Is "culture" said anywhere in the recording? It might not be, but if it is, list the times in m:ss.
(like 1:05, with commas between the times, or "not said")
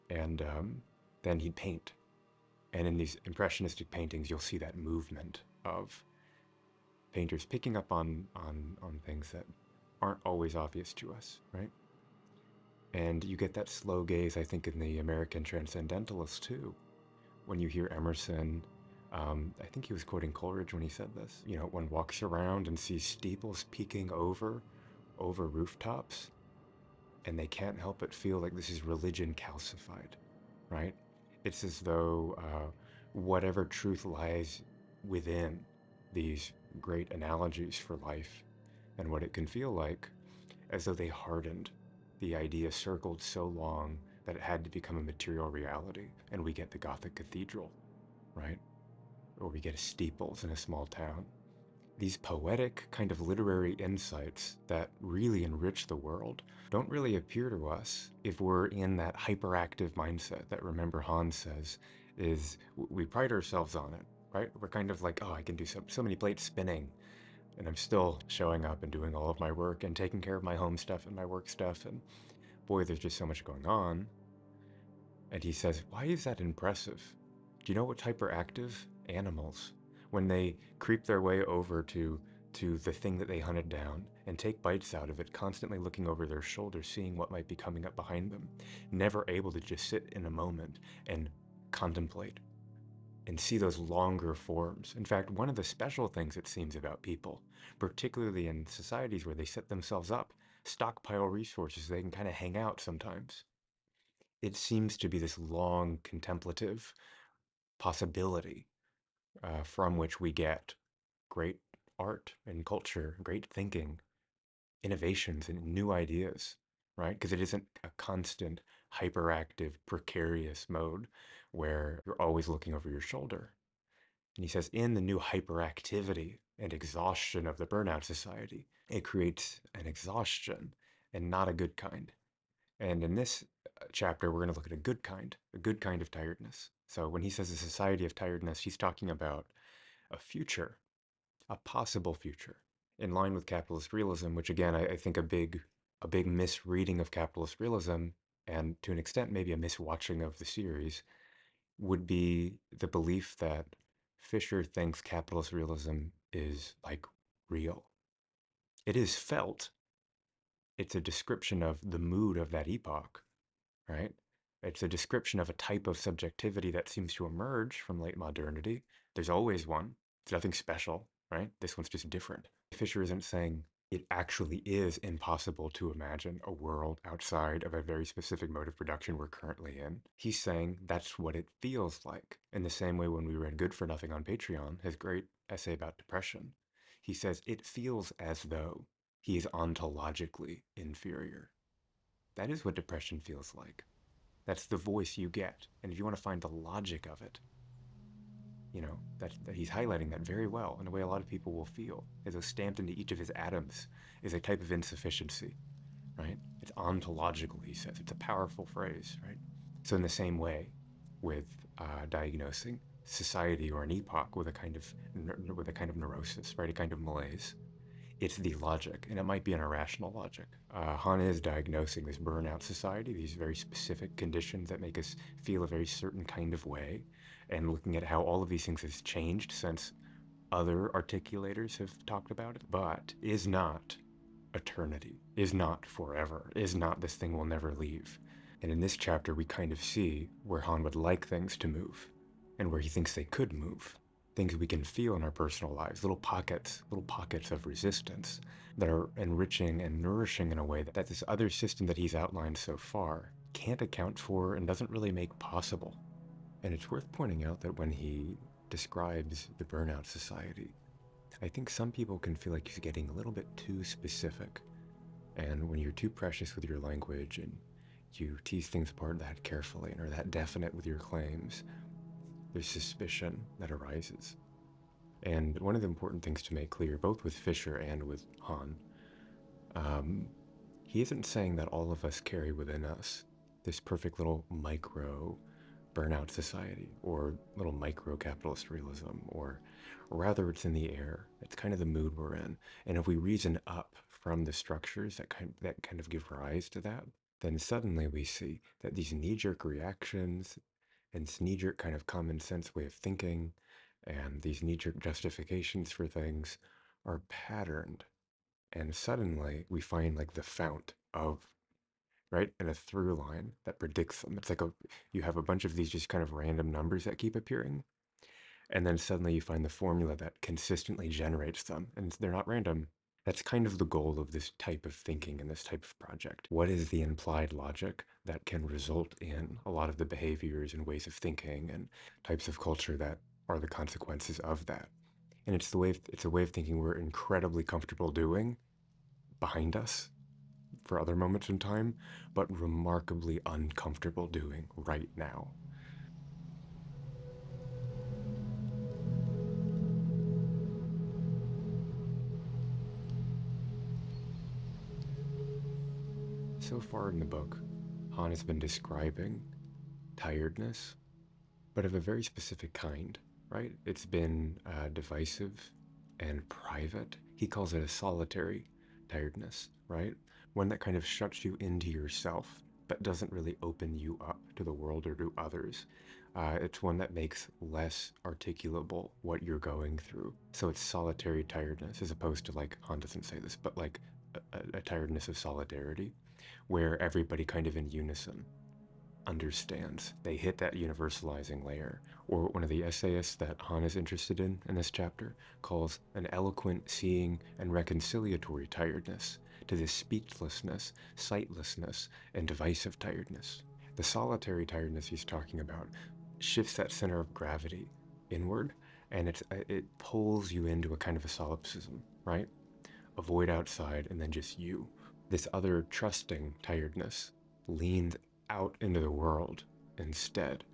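1:52, 5:32.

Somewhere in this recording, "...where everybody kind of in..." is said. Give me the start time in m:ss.
6:26.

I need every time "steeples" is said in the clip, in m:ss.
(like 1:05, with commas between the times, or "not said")
0:23, 0:49.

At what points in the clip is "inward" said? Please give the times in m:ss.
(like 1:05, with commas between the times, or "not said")
6:48.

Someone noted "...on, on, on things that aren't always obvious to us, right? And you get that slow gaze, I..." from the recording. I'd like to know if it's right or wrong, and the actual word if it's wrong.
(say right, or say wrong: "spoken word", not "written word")
right.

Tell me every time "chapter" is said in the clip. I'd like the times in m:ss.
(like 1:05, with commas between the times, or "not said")
2:13, 3:58, 6:34.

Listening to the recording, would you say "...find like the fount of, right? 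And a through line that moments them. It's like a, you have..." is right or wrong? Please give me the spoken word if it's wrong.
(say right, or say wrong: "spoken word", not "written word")
wrong: "predicts", not "moments".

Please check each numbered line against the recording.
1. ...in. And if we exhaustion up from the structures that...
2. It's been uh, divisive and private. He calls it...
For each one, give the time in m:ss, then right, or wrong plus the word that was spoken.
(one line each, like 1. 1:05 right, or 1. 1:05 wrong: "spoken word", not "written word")
1. 4:52 wrong: "reason", not "exhaustion"
2. 6:03 right.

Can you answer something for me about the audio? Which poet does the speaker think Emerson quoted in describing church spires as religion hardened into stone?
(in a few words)
Coleridge.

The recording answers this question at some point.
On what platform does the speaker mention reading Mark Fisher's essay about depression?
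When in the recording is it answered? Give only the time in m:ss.
3:04.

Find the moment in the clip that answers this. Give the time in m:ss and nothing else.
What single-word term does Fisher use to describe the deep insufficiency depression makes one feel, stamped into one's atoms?
3:09.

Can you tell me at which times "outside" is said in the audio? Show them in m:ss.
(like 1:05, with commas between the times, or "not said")
2:57, 6:53.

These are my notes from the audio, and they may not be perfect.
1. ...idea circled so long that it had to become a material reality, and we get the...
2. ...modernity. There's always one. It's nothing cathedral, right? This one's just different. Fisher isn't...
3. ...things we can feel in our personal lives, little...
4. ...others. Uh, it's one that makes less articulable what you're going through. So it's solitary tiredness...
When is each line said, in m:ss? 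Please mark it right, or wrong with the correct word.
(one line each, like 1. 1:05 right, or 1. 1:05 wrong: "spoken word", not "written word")
1. 0:42 right
2. 2:48 wrong: "special", not "cathedral"
3. 4:04 right
4. 6:15 right.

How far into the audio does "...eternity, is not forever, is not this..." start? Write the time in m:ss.
3:54.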